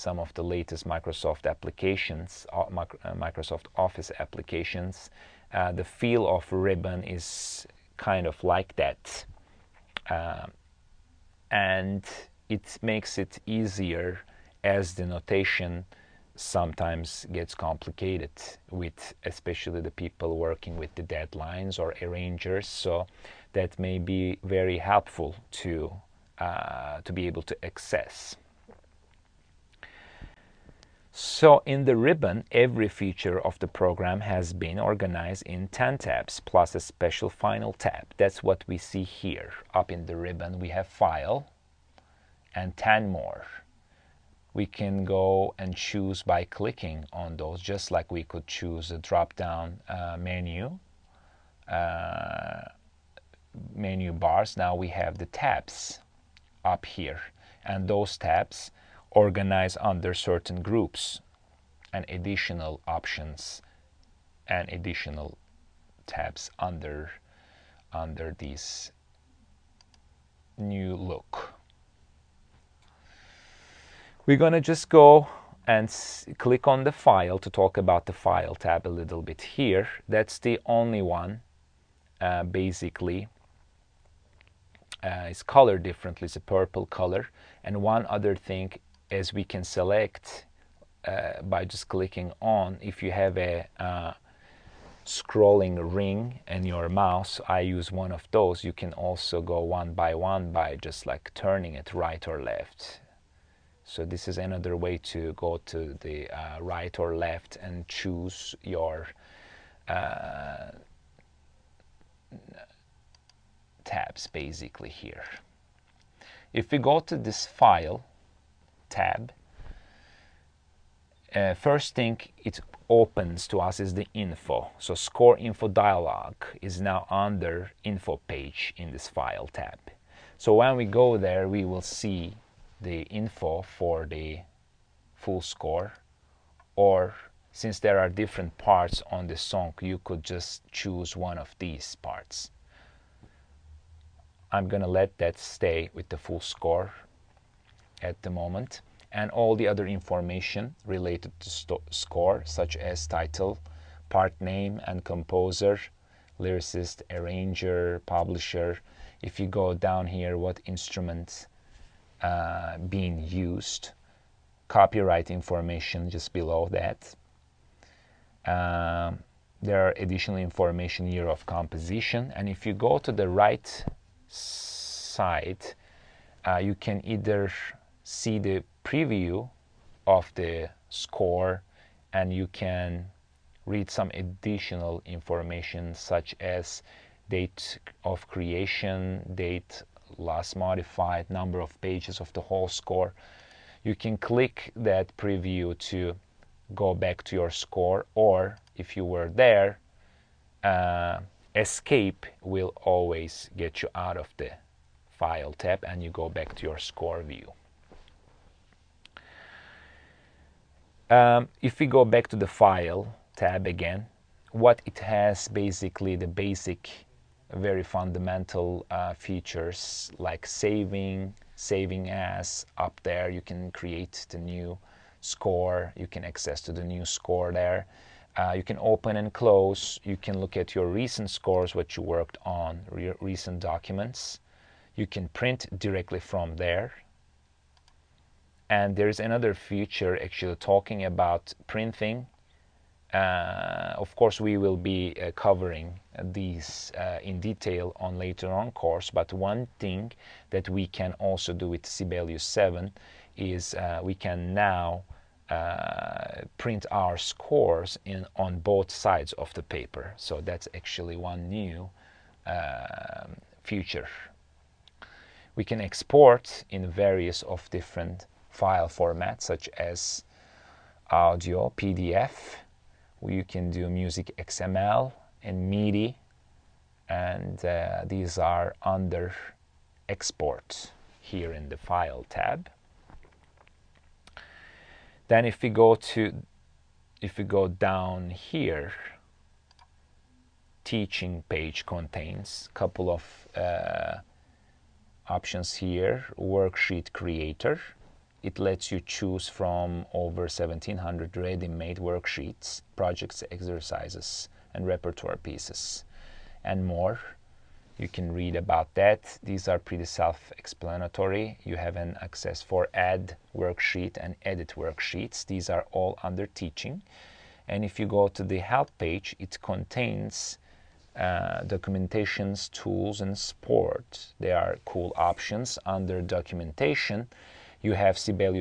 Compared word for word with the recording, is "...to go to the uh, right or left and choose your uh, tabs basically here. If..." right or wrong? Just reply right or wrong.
right.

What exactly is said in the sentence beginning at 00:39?
Up in the ribbon, we have File and 10 more.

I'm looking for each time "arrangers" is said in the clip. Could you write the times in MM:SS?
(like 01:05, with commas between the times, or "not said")
00:21, 02:37.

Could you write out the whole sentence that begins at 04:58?
It lets you choose from over 1700 ready-made worksheets, projects, exercises, and repertoire pieces, and more.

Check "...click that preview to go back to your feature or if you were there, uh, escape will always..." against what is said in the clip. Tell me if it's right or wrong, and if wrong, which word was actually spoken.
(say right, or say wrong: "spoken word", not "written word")
wrong: "score", not "feature".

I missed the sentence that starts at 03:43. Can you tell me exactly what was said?
You can create the new score.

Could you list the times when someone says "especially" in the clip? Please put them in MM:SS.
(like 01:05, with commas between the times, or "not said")
00:19.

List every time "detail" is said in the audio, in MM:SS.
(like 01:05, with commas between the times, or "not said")
04:07.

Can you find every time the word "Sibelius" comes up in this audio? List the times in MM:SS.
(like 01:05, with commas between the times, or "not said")
04:11.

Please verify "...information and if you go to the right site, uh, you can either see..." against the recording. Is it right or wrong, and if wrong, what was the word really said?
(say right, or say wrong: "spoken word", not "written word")
wrong: "composition", not "information".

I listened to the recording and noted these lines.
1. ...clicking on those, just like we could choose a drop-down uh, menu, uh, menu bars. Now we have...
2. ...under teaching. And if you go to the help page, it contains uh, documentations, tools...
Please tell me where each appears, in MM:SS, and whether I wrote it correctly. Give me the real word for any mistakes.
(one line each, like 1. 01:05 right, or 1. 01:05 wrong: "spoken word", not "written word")
1. 00:46 right
2. 05:16 right.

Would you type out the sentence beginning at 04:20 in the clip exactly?
So that's actually one new uh, um, feature.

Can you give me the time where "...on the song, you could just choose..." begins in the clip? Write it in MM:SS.
02:19.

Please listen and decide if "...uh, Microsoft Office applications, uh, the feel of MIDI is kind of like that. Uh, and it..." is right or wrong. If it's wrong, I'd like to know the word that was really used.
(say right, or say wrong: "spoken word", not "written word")
wrong: "Ribbon", not "MIDI".